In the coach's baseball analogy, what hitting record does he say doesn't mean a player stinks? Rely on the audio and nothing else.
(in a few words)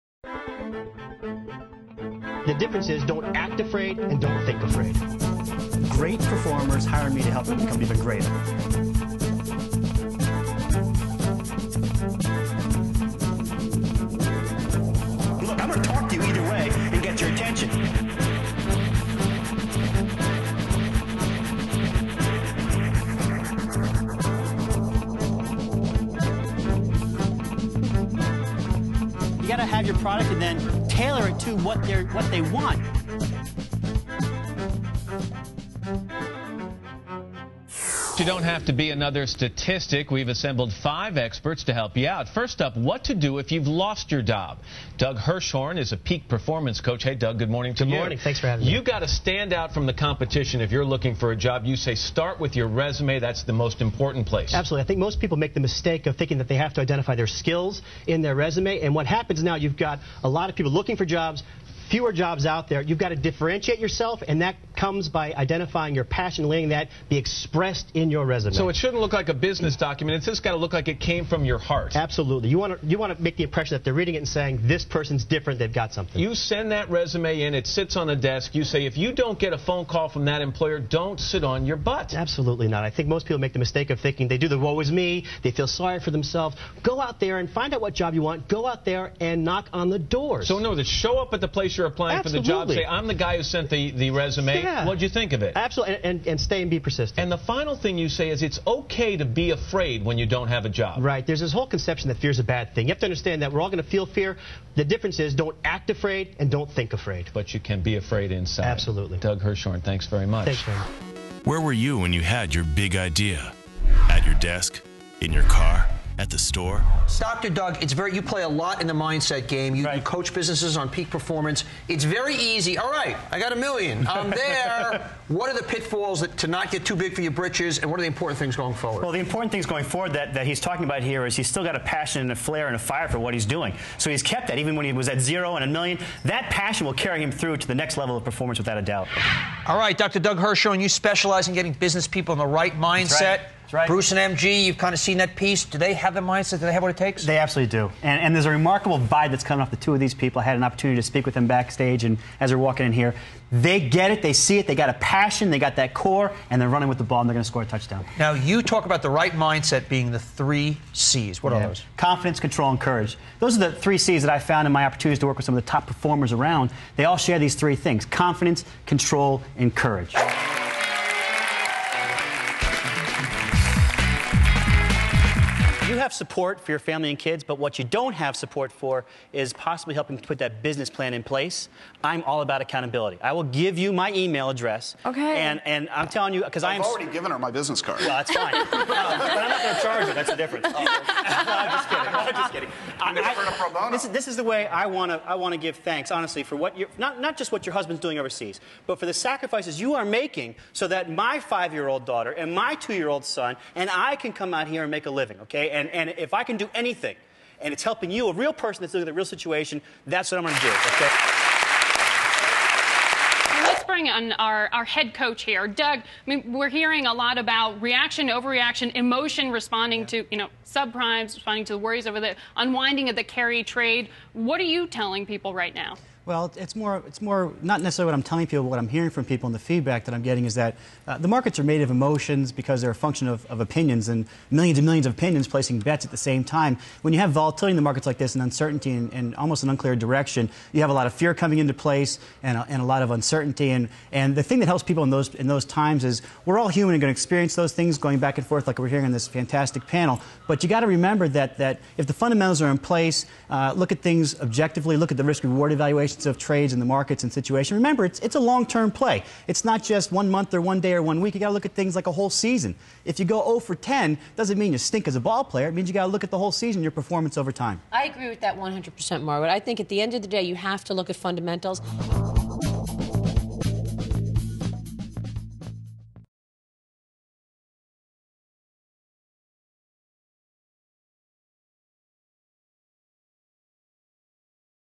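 0 for 10.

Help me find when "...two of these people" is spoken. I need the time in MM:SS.
02:29.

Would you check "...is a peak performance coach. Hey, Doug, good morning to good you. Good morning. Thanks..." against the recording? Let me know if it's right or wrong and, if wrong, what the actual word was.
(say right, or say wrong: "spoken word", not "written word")
right.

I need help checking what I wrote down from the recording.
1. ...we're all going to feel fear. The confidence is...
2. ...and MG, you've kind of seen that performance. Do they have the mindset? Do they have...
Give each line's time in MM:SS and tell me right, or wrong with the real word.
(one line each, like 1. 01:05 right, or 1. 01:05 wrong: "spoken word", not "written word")
1. 01:43 wrong: "difference", not "confidence"
2. 02:24 wrong: "piece", not "performance".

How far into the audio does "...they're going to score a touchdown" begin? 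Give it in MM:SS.
02:37.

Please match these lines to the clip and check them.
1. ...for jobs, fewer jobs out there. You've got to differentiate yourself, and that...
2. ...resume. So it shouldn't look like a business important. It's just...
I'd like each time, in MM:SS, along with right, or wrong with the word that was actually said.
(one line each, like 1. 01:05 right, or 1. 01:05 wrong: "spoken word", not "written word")
1. 01:00 right
2. 01:08 wrong: "document", not "important".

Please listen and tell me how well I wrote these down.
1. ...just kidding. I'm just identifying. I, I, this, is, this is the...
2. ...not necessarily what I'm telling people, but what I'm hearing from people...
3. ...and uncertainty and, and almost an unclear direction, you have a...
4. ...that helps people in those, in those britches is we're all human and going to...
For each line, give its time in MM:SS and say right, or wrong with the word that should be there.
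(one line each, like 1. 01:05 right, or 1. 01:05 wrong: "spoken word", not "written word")
1. 03:11 wrong: "kidding", not "identifying"
2. 03:47 right
3. 03:58 right
4. 04:04 wrong: "times", not "britches".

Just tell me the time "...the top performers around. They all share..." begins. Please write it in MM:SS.
02:45.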